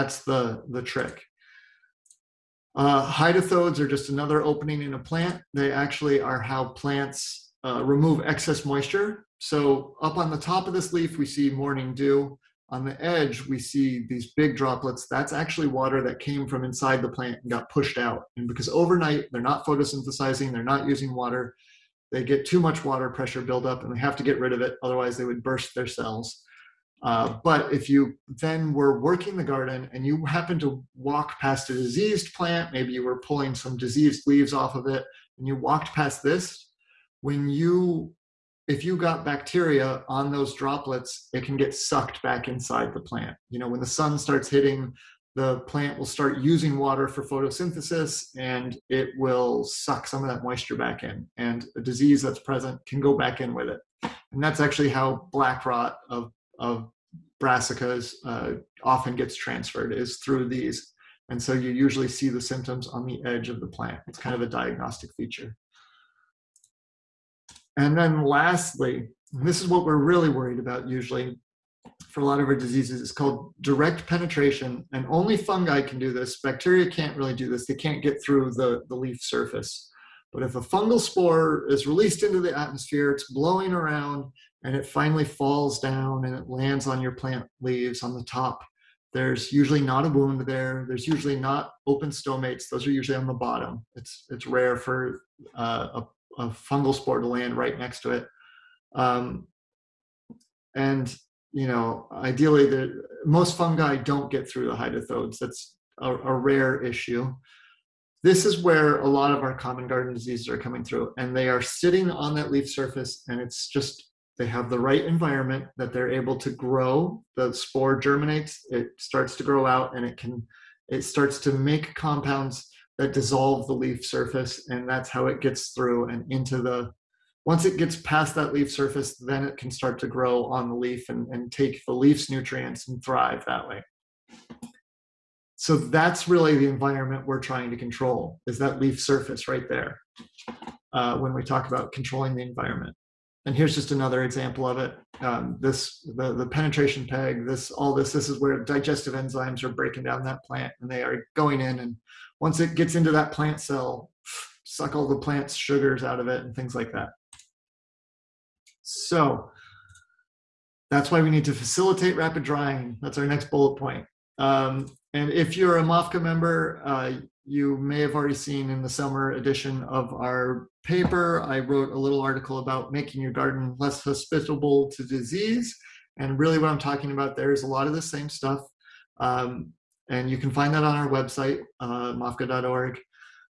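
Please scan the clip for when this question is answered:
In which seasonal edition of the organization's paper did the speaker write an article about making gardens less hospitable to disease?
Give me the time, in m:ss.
2:48.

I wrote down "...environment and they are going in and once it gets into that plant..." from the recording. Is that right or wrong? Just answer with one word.
wrong.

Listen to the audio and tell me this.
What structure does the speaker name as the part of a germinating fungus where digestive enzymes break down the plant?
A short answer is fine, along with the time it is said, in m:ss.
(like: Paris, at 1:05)
Penetration peg, at 2:26.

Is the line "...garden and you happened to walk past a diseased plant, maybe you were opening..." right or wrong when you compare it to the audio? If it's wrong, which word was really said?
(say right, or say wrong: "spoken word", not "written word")
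wrong: "pulling", not "opening".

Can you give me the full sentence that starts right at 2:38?
So that's why we need to facilitate rapid drying.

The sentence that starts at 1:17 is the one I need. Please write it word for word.
They can't get through the, the leaf surface.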